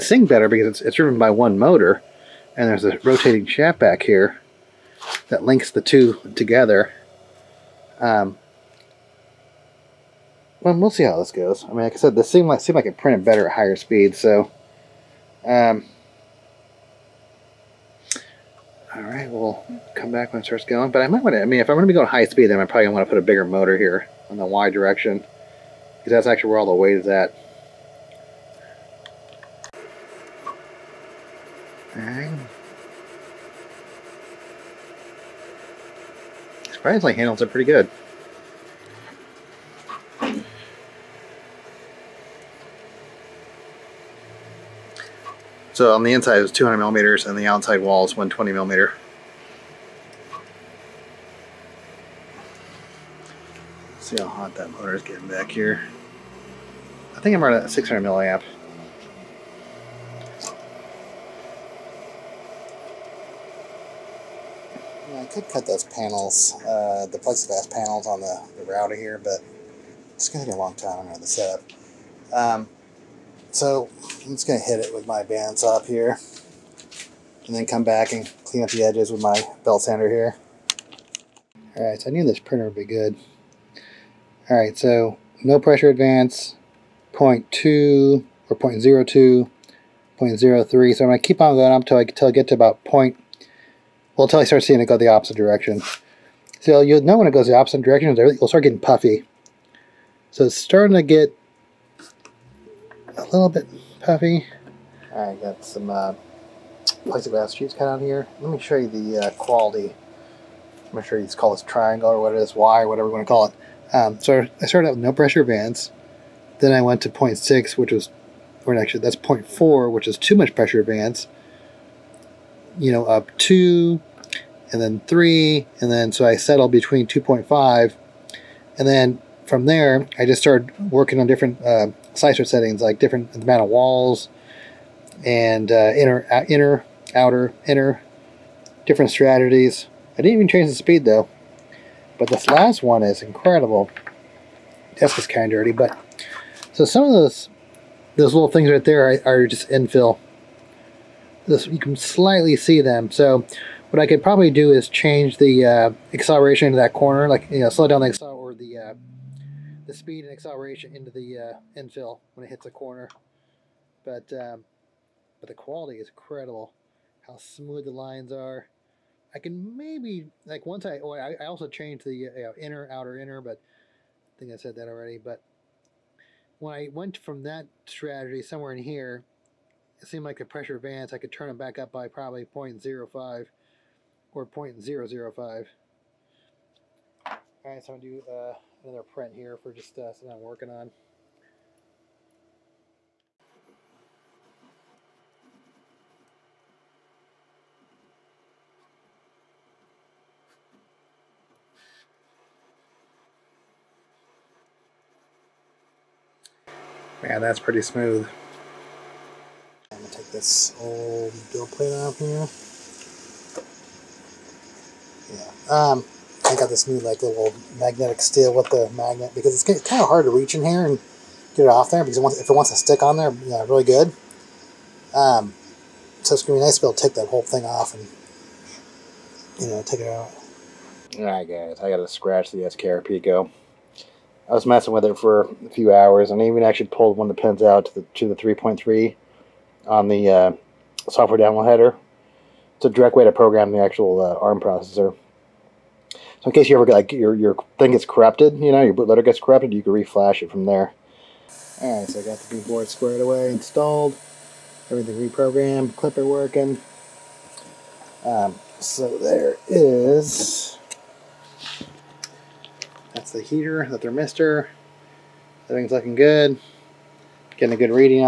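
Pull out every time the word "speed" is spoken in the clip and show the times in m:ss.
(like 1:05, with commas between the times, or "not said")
0:13, 0:22, 2:20, 2:39.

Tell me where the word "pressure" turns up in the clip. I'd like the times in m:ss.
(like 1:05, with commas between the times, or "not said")
1:25, 1:55, 2:00, 3:00.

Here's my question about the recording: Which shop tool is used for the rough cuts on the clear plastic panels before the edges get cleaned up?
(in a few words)
bandsaw.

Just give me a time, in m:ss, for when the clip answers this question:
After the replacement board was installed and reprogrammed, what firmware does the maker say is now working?
4:15.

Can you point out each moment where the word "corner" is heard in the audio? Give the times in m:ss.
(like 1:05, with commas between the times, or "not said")
2:36, 2:42.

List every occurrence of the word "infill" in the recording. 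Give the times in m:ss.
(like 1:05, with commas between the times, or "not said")
2:29, 2:41.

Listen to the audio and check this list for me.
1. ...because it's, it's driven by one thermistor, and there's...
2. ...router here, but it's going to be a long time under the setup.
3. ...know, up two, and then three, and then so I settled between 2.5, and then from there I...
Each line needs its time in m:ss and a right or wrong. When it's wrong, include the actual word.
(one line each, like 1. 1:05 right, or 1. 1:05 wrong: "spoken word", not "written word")
1. 0:00 wrong: "motor", not "thermistor"
2. 1:08 right
3. 2:02 right.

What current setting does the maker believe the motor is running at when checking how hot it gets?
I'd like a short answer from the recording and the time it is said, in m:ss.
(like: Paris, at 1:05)
600 milliamps, at 0:57.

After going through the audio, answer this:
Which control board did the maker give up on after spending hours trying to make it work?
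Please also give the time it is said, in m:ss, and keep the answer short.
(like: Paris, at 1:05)
SKR Pico, at 3:52.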